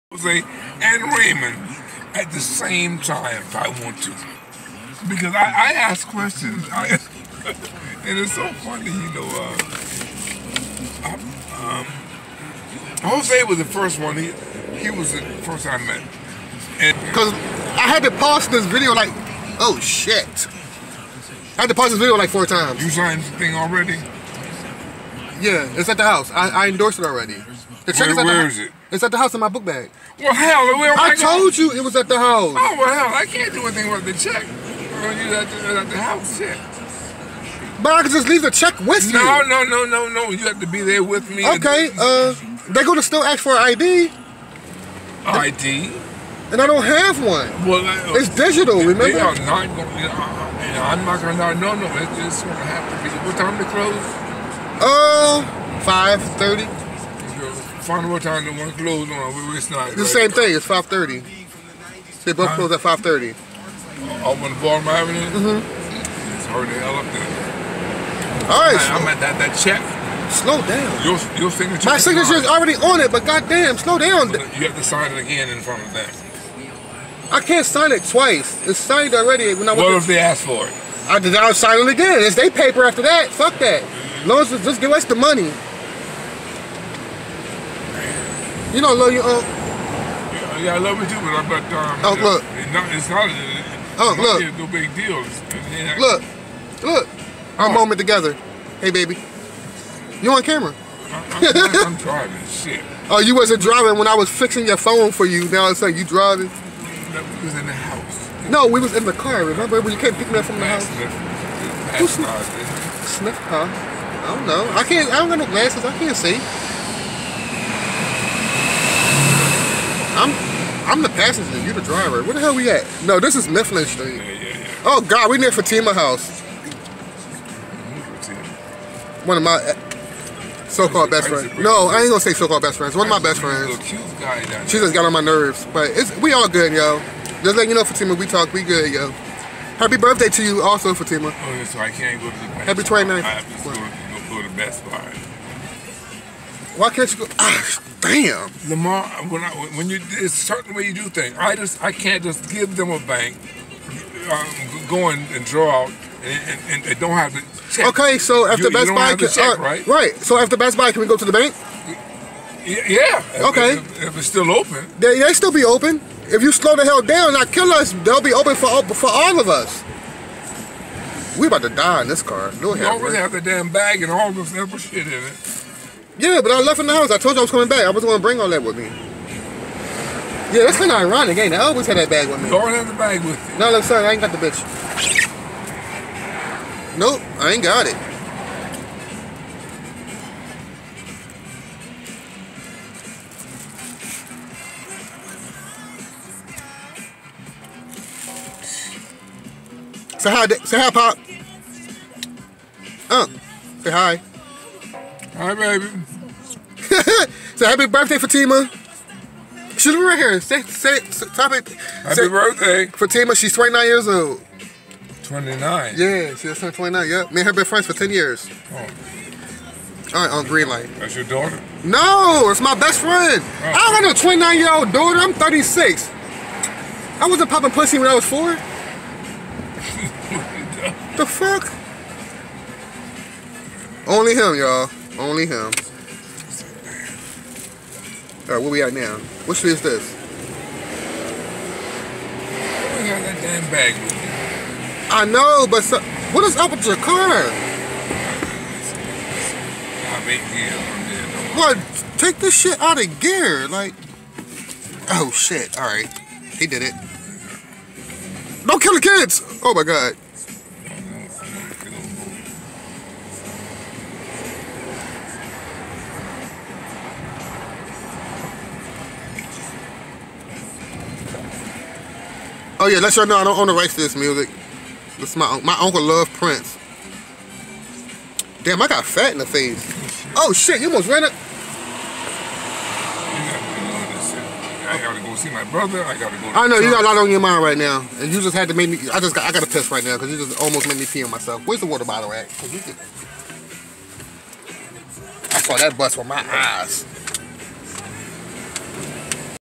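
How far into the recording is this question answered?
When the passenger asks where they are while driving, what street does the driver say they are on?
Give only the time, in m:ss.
2:03.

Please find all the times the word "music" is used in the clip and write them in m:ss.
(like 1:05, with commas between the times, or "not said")
4:34.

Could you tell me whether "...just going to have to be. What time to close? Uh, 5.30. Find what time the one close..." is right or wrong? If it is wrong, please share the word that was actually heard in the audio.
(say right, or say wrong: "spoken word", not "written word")
right.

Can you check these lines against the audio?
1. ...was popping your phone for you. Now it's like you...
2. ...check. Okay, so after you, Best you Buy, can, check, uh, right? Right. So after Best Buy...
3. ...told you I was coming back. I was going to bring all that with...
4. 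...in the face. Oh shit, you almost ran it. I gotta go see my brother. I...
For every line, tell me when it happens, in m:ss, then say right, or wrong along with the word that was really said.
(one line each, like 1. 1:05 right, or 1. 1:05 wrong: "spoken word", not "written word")
1. 1:44 wrong: "fixing", not "popping"
2. 2:37 right
3. 2:57 right
4. 4:39 right.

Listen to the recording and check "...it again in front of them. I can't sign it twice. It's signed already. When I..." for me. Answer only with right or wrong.
right.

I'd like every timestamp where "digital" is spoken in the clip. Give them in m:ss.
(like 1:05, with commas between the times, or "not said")
0:48.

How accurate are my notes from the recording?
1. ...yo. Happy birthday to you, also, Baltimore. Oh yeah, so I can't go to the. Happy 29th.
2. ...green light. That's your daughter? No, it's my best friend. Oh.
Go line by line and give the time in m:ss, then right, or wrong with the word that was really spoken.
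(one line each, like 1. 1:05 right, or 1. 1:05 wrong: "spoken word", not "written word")
1. 2:18 wrong: "Fatima", not "Baltimore"
2. 3:40 right.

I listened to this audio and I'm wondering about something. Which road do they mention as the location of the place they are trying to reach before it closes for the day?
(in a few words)
Baltimore Avenue.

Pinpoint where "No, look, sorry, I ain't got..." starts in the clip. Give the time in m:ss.
3:03.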